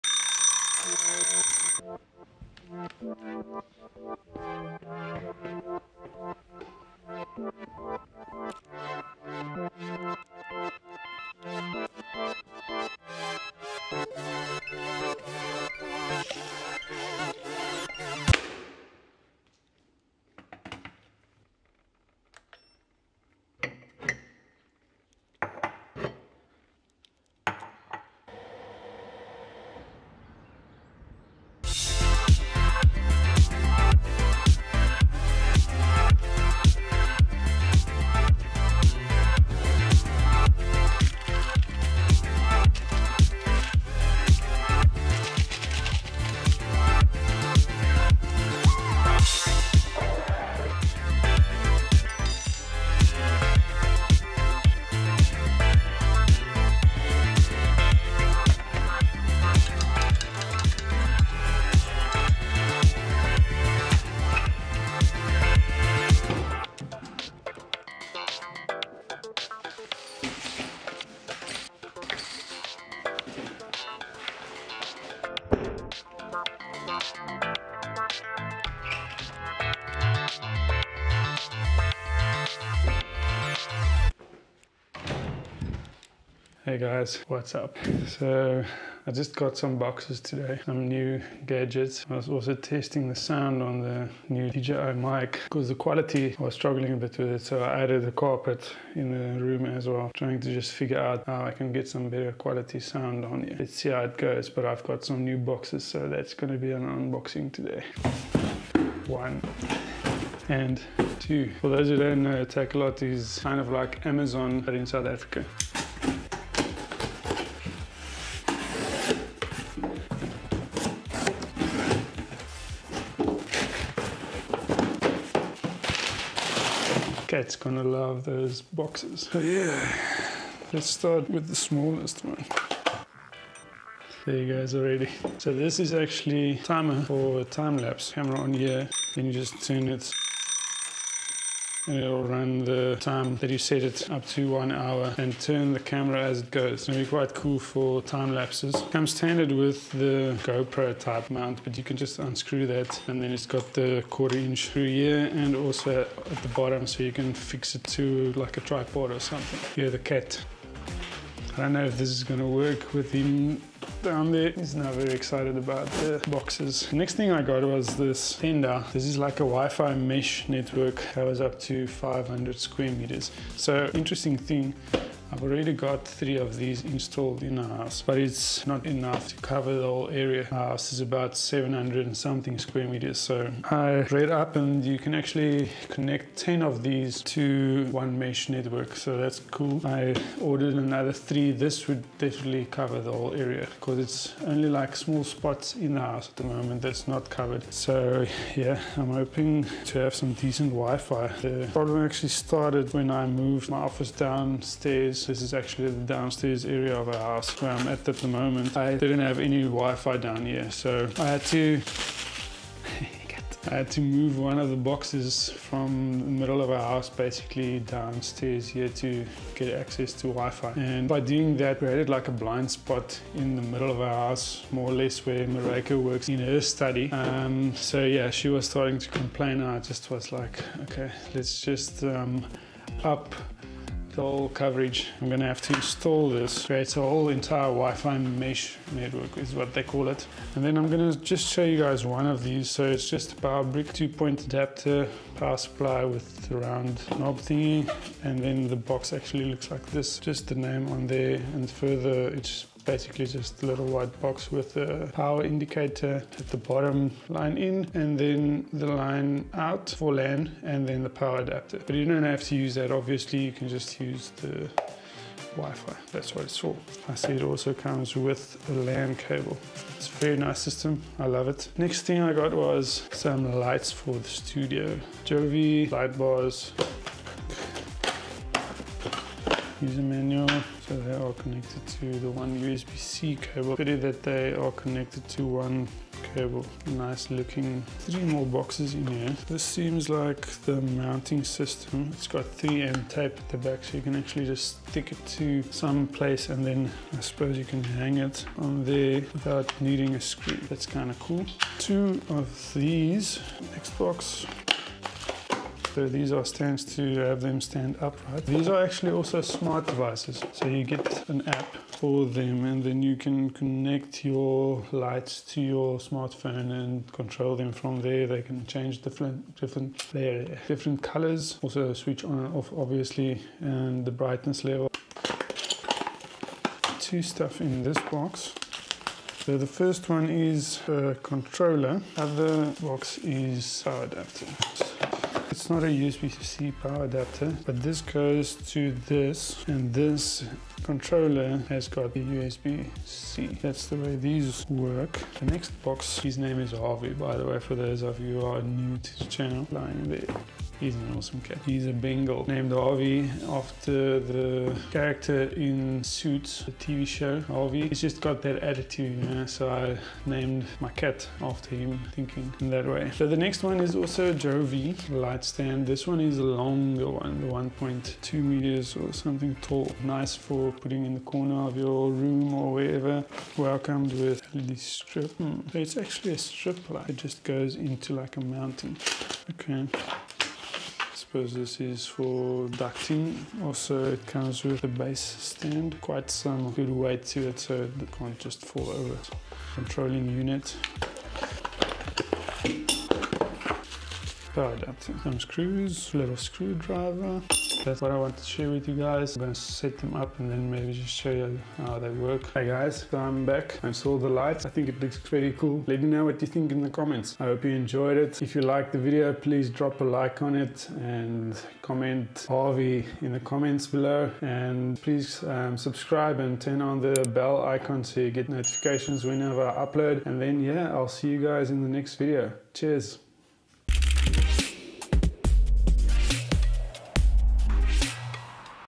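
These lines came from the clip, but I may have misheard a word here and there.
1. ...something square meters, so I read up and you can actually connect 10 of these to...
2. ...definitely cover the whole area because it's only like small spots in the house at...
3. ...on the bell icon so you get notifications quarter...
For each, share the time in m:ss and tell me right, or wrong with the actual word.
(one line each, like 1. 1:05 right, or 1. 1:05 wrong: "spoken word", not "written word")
1. 3:02 right
2. 3:12 right
3. 6:56 wrong: "whenever", not "quarter".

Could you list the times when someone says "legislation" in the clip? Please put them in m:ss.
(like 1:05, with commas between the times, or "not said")
not said.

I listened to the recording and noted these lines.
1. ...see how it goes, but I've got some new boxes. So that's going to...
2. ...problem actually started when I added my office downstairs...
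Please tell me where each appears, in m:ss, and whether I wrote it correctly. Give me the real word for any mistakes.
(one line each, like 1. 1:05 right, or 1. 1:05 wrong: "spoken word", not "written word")
1. 1:43 right
2. 3:21 wrong: "moved", not "added".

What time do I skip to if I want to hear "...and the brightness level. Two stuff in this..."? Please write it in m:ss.
5:23.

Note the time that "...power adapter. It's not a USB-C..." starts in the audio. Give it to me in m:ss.
5:33.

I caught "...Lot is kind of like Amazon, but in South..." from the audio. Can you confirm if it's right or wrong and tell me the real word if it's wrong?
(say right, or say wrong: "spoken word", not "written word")
right.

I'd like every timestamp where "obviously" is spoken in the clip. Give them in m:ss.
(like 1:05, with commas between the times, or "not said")
4:22, 5:22.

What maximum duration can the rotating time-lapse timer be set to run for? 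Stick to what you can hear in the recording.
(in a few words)
1 hour.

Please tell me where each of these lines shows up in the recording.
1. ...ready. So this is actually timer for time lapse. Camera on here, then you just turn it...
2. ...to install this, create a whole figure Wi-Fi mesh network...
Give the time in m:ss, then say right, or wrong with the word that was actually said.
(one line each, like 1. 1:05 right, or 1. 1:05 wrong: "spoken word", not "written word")
1. 2:14 right
2. 3:55 wrong: "entire", not "figure".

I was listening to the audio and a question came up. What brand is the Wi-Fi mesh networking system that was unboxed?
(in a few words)
Tenda.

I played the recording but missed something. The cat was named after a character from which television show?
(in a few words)
Suits.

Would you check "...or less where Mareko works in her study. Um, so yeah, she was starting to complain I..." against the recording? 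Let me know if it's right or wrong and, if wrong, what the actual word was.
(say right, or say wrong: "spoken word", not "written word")
right.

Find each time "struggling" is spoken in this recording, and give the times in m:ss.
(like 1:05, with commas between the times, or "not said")
1:36.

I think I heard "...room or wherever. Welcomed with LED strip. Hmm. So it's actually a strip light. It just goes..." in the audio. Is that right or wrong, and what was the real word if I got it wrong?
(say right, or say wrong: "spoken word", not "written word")
right.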